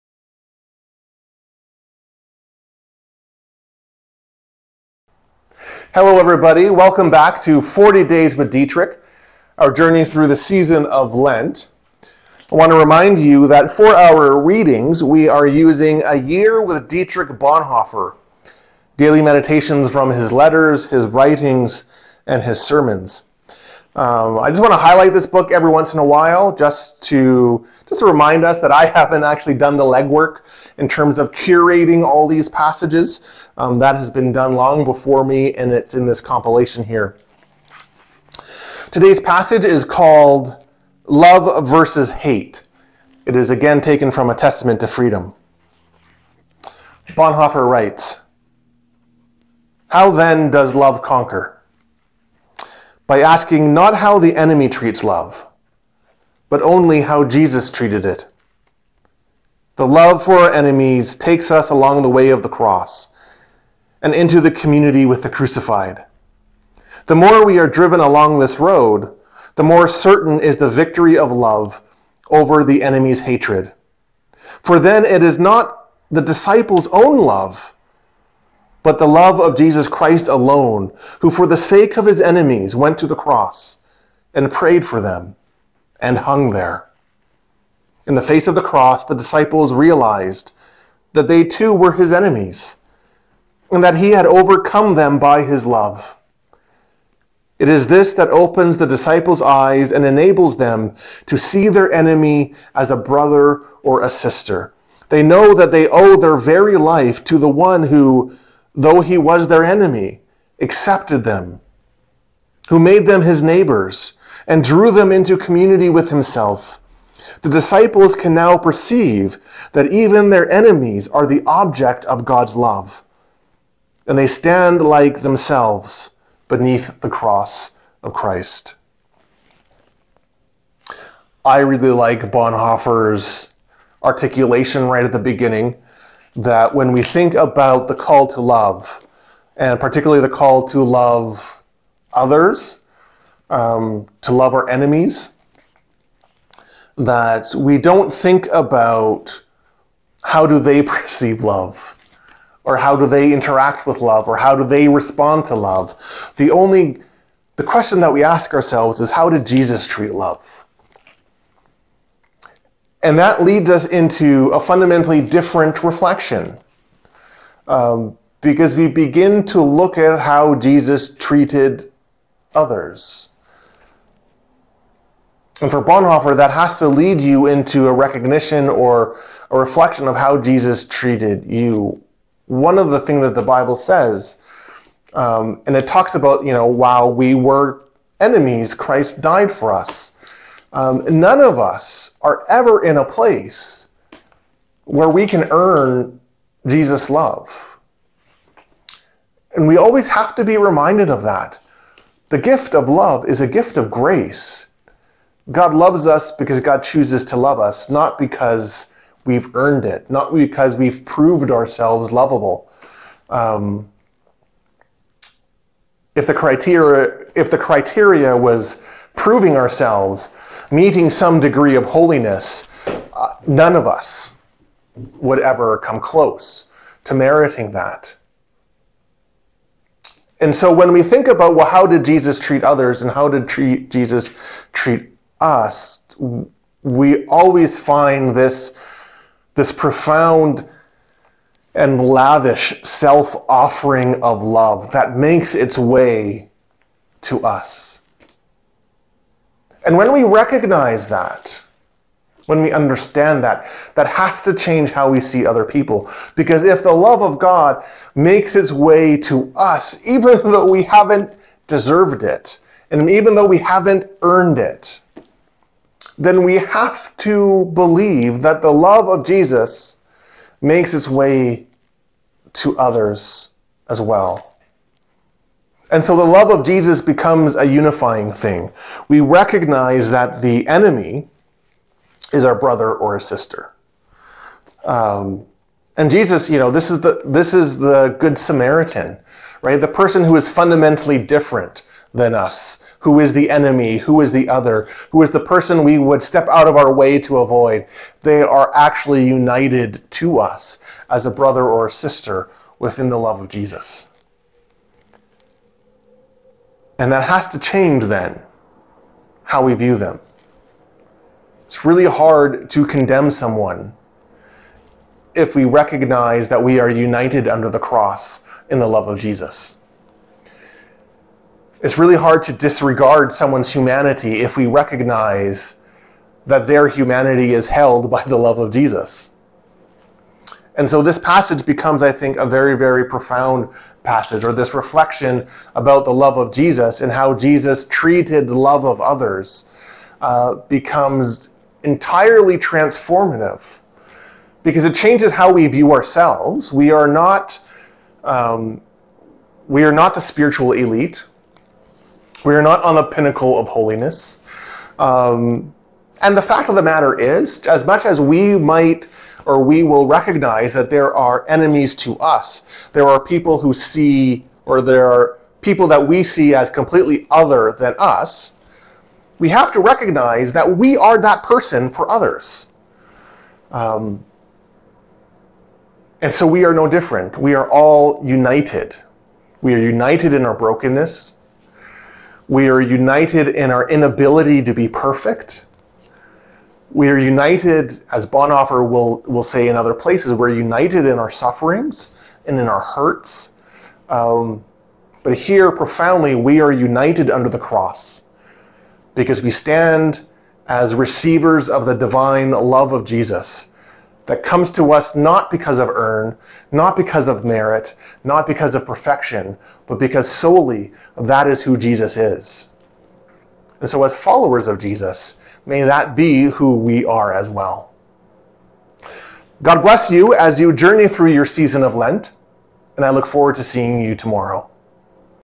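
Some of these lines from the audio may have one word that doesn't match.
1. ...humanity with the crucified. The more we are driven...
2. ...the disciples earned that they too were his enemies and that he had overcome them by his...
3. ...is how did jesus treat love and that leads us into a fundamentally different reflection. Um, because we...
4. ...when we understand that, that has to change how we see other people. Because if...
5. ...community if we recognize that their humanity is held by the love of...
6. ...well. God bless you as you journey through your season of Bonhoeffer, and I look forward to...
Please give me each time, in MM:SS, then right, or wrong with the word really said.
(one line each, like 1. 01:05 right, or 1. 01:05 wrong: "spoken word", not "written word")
1. 01:04 wrong: "community", not "humanity"
2. 01:29 wrong: "realized", not "earned"
3. 02:39 right
4. 04:12 right
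5. 05:23 wrong: "humanity", not "community"
6. 06:57 wrong: "Lent", not "Bonhoeffer".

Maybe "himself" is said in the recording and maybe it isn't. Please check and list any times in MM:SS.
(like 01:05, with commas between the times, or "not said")
01:56.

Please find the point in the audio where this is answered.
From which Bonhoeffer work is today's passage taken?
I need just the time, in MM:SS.
00:44.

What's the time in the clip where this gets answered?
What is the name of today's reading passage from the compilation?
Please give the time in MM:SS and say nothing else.
00:41.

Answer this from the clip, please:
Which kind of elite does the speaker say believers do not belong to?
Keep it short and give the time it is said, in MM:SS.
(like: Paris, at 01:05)
the spiritual elite, at 05:50.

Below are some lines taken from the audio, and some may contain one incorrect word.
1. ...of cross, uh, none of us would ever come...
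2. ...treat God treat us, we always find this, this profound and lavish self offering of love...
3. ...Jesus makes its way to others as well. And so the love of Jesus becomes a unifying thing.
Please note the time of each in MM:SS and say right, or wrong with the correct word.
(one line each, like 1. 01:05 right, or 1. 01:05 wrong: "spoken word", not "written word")
1. 03:41 wrong: "holiness", not "cross"
2. 03:53 wrong: "Jesus", not "God"
3. 04:29 right.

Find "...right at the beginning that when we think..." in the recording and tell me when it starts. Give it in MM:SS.
02:14.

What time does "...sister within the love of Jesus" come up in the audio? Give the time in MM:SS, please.
05:01.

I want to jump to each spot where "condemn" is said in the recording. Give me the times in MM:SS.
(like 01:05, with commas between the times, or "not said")
05:12.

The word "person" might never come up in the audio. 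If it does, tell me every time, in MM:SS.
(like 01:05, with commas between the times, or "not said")
04:49, 04:55, 06:11.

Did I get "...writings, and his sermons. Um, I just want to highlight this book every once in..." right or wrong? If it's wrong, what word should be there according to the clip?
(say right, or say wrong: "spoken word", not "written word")
right.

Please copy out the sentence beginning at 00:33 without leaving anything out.
Um, that has been done long before me and it's in this compilation here.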